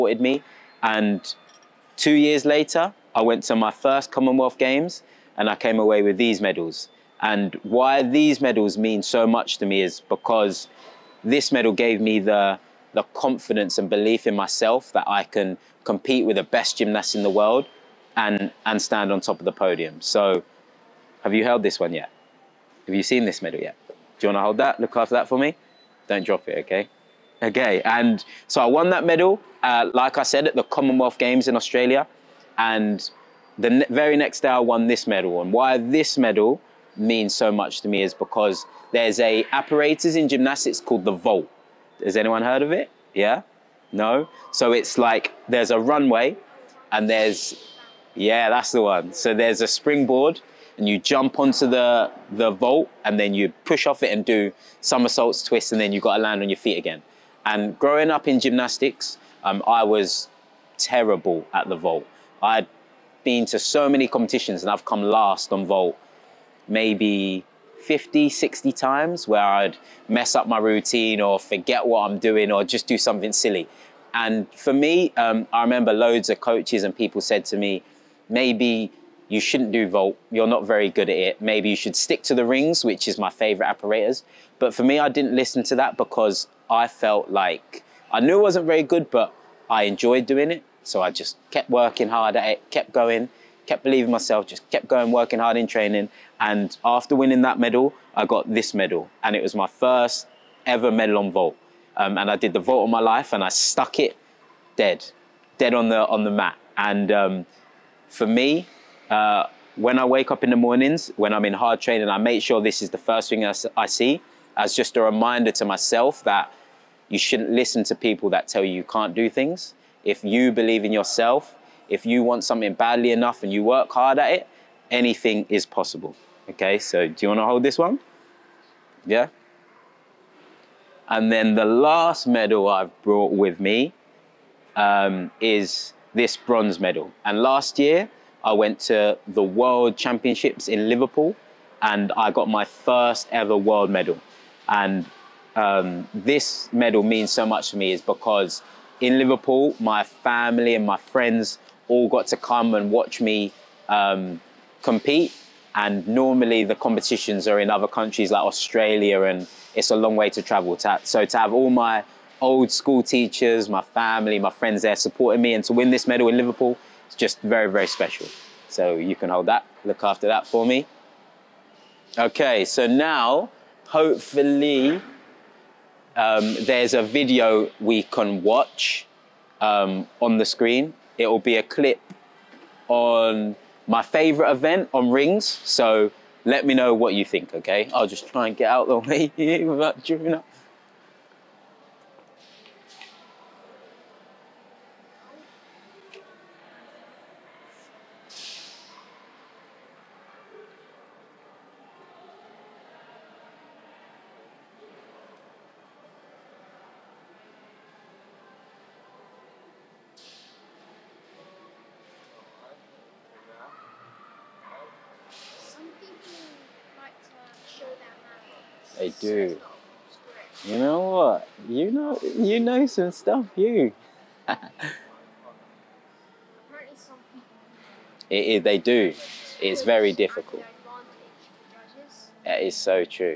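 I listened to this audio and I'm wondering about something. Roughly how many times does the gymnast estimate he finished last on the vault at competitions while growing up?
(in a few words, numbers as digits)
50, 60.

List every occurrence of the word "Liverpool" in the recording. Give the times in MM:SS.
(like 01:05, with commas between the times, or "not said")
02:20, 02:29, 02:46.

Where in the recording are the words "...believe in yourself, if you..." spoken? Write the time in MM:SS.
02:00.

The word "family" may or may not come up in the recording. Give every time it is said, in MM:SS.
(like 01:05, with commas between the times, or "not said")
02:30, 02:43.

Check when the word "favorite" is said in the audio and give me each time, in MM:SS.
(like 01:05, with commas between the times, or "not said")
01:23, 03:04.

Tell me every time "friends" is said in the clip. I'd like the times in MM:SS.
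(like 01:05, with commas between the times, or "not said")
02:30, 02:44.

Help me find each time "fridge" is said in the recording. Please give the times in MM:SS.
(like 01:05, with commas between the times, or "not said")
not said.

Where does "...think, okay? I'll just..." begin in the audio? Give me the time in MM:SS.
03:07.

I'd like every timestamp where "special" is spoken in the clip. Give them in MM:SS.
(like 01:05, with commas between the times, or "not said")
02:47.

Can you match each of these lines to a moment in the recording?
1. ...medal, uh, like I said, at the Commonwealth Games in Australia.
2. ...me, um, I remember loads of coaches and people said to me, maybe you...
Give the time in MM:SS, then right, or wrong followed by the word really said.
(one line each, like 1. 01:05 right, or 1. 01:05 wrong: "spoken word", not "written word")
1. 00:29 right
2. 01:14 right.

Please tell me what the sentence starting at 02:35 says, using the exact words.
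And normally the competitions are in other countries like Australia, and it's a long way to travel.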